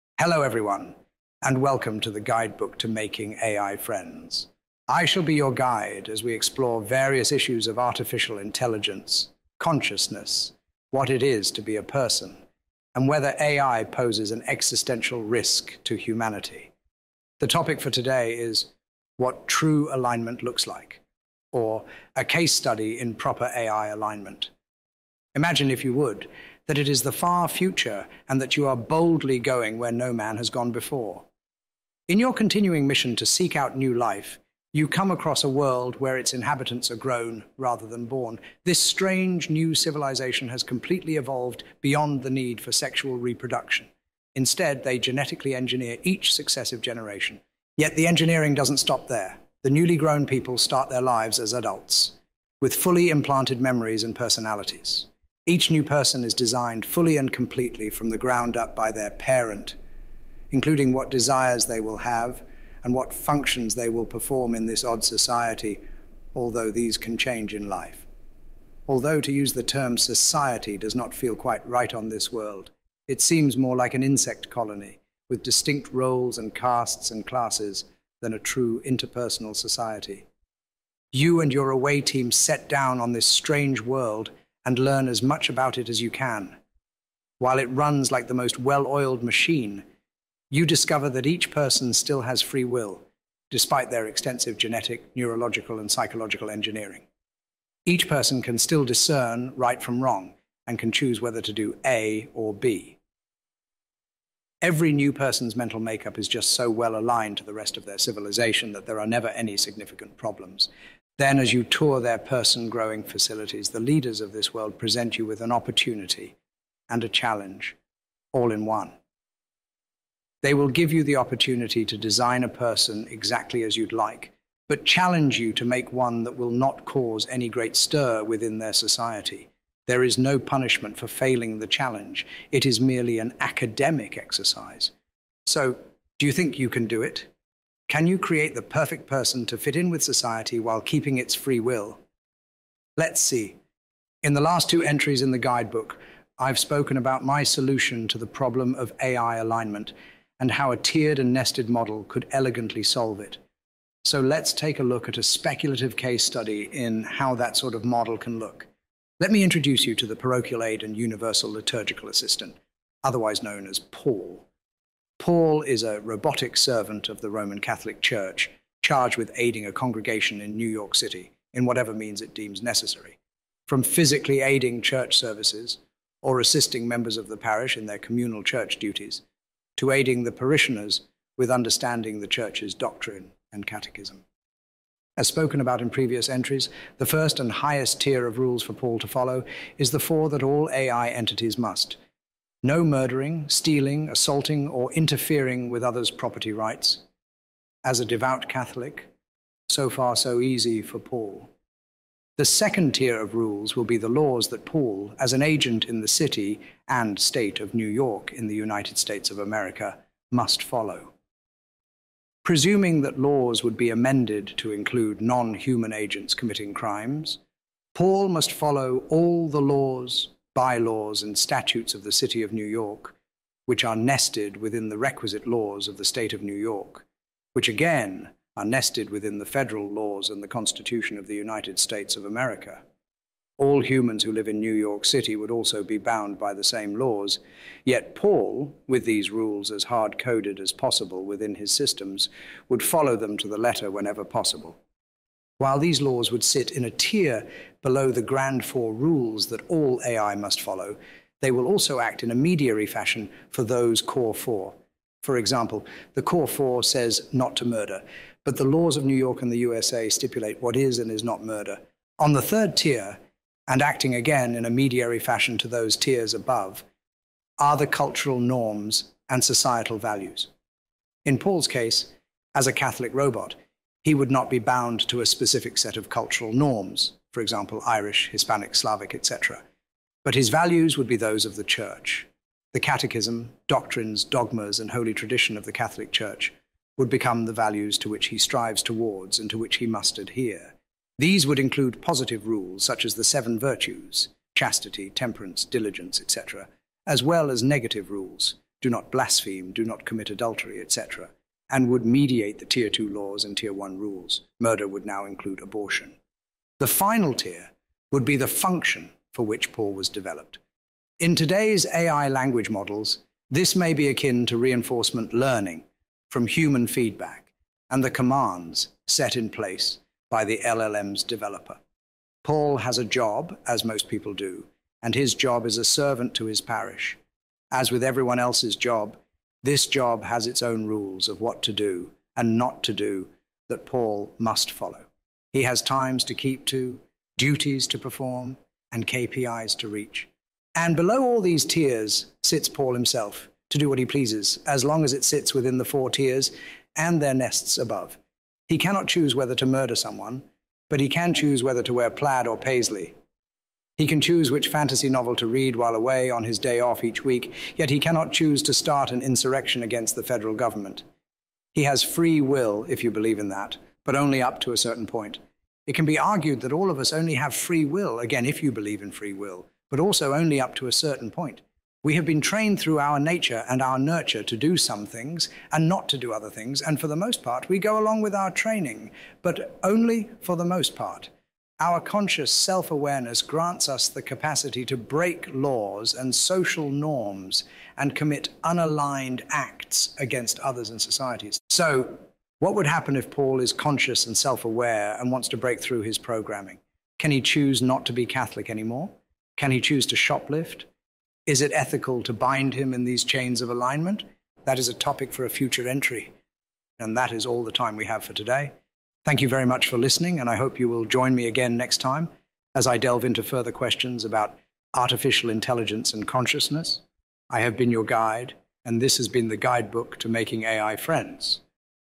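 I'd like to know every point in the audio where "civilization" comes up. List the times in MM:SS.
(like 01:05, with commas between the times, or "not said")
00:39, 01:47.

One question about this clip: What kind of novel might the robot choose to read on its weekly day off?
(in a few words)
fantasy.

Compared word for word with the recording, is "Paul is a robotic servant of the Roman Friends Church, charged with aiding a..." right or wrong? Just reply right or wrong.
wrong.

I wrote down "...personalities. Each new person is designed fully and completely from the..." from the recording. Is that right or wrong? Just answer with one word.
right.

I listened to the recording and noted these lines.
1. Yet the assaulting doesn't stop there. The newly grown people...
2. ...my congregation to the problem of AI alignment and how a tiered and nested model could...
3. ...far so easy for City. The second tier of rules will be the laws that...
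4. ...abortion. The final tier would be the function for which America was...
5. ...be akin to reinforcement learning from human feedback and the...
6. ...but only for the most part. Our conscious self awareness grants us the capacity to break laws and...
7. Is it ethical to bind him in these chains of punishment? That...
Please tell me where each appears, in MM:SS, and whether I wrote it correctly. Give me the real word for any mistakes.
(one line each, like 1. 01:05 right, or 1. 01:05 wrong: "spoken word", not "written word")
1. 00:47 wrong: "engineering", not "assaulting"
2. 02:27 wrong: "solution", not "congregation"
3. 03:19 wrong: "Paul", not "City"
4. 05:05 wrong: "Paul", not "America"
5. 05:13 right
6. 06:19 right
7. 06:41 wrong: "alignment", not "punishment".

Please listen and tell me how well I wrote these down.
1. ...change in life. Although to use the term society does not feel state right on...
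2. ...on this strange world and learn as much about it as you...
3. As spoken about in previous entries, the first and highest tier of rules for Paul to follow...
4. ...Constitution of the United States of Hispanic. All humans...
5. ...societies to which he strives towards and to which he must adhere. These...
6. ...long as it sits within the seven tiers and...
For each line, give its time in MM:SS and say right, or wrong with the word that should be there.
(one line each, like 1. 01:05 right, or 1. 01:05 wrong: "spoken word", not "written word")
1. 01:07 wrong: "quite", not "state"
2. 01:23 right
3. 03:05 right
4. 03:50 wrong: "America", not "Hispanic"
5. 04:47 wrong: "values", not "societies"
6. 05:44 wrong: "four", not "seven".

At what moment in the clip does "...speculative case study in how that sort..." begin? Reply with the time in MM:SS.
02:35.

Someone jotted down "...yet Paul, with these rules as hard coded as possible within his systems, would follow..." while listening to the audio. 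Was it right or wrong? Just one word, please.
right.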